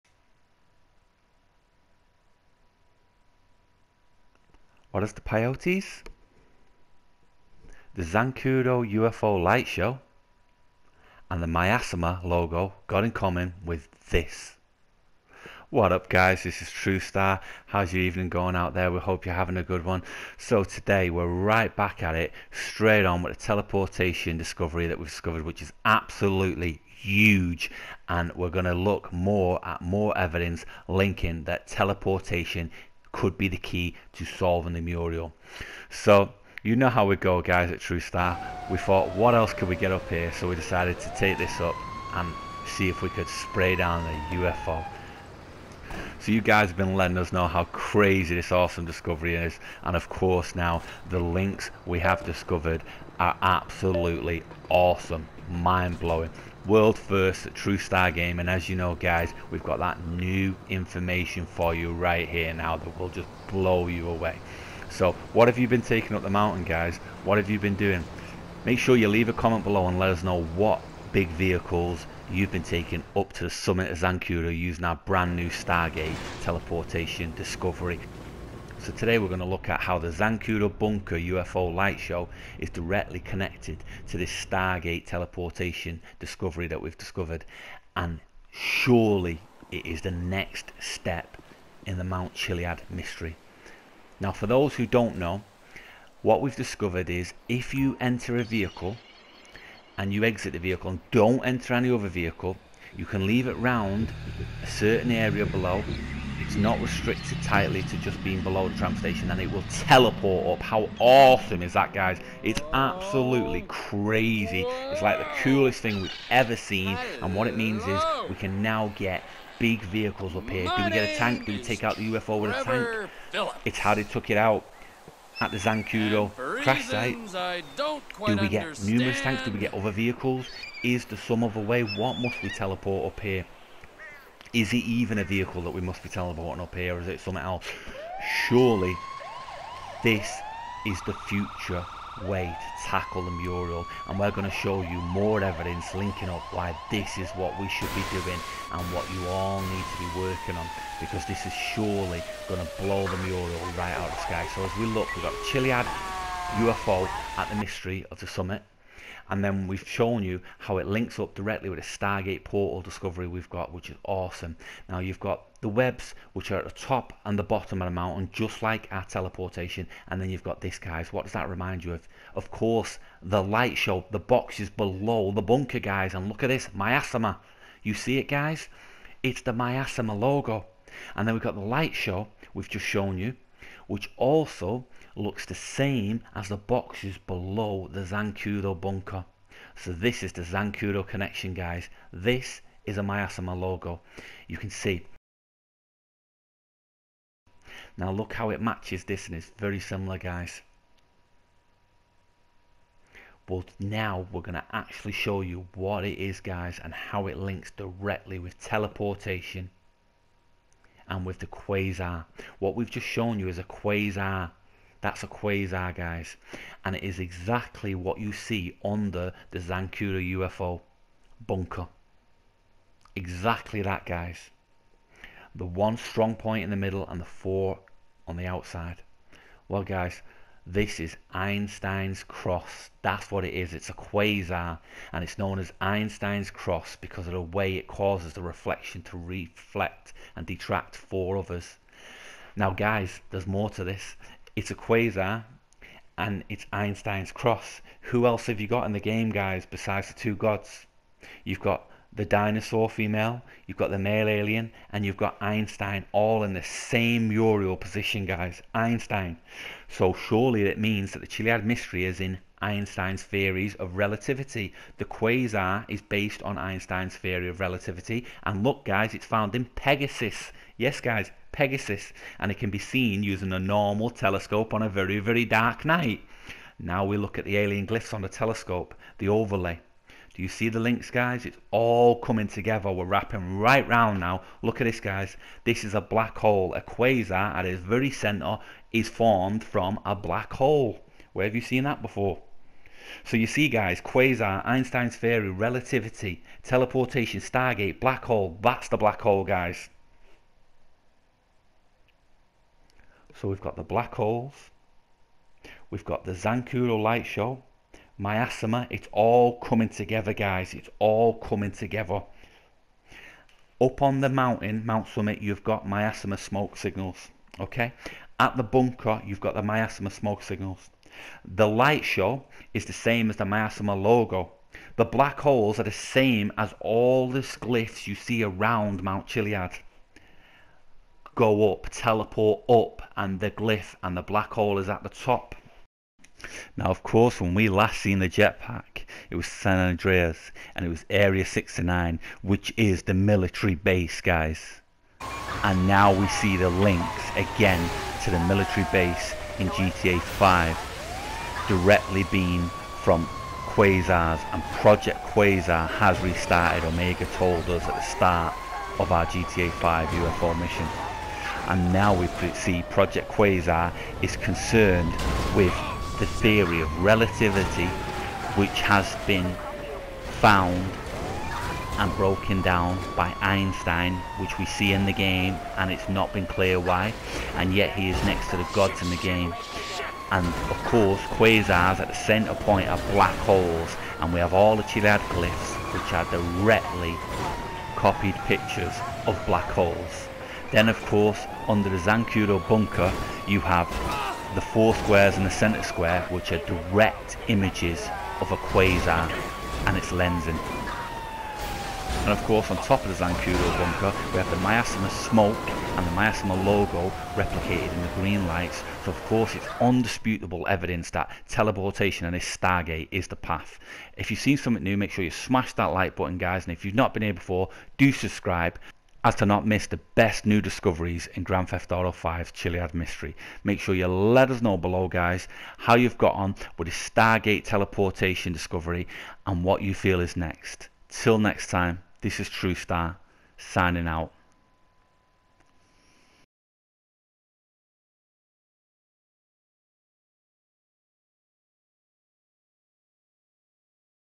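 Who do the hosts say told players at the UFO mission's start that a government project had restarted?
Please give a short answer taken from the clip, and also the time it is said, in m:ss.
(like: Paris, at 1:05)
Omega, at 5:56.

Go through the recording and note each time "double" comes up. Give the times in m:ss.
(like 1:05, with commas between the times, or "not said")
not said.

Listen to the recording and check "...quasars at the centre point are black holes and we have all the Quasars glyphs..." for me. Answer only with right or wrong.
wrong.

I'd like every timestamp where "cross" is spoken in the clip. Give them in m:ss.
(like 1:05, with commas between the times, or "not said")
3:52, 3:56, 4:07.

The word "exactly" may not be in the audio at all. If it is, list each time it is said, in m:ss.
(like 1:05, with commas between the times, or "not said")
3:37, 3:43.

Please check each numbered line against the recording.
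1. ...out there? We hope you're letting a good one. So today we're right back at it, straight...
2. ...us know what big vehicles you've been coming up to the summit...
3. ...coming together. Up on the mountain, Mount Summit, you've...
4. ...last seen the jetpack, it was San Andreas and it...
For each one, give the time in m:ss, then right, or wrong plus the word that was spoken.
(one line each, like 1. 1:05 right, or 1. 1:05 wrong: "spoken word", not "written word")
1. 0:18 wrong: "having", not "letting"
2. 1:10 wrong: "taking", not "coming"
3. 5:11 right
4. 5:37 right.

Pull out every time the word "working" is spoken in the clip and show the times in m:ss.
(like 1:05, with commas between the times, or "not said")
2:30.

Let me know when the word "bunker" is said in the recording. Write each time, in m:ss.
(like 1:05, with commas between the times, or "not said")
1:20, 2:55, 3:08, 3:41, 5:18, 6:32, 6:43.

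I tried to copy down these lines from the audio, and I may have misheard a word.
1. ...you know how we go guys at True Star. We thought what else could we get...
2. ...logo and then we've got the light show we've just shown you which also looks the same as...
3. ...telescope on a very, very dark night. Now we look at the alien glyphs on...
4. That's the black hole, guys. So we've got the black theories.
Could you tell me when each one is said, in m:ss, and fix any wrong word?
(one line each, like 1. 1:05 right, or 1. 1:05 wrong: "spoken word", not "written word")
1. 0:36 right
2. 3:00 right
3. 4:34 right
4. 4:58 wrong: "holes", not "theories".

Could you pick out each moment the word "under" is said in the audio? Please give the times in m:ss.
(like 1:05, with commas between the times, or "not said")
3:38, 6:31.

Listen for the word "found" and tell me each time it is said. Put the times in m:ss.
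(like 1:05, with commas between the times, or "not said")
4:29, 6:10.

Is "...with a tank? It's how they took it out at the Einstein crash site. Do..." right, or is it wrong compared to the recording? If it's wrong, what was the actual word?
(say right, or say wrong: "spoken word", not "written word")
wrong: "Zancudo", not "Einstein".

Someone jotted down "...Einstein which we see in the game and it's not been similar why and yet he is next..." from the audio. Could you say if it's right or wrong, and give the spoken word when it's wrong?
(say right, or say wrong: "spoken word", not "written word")
wrong: "clear", not "similar".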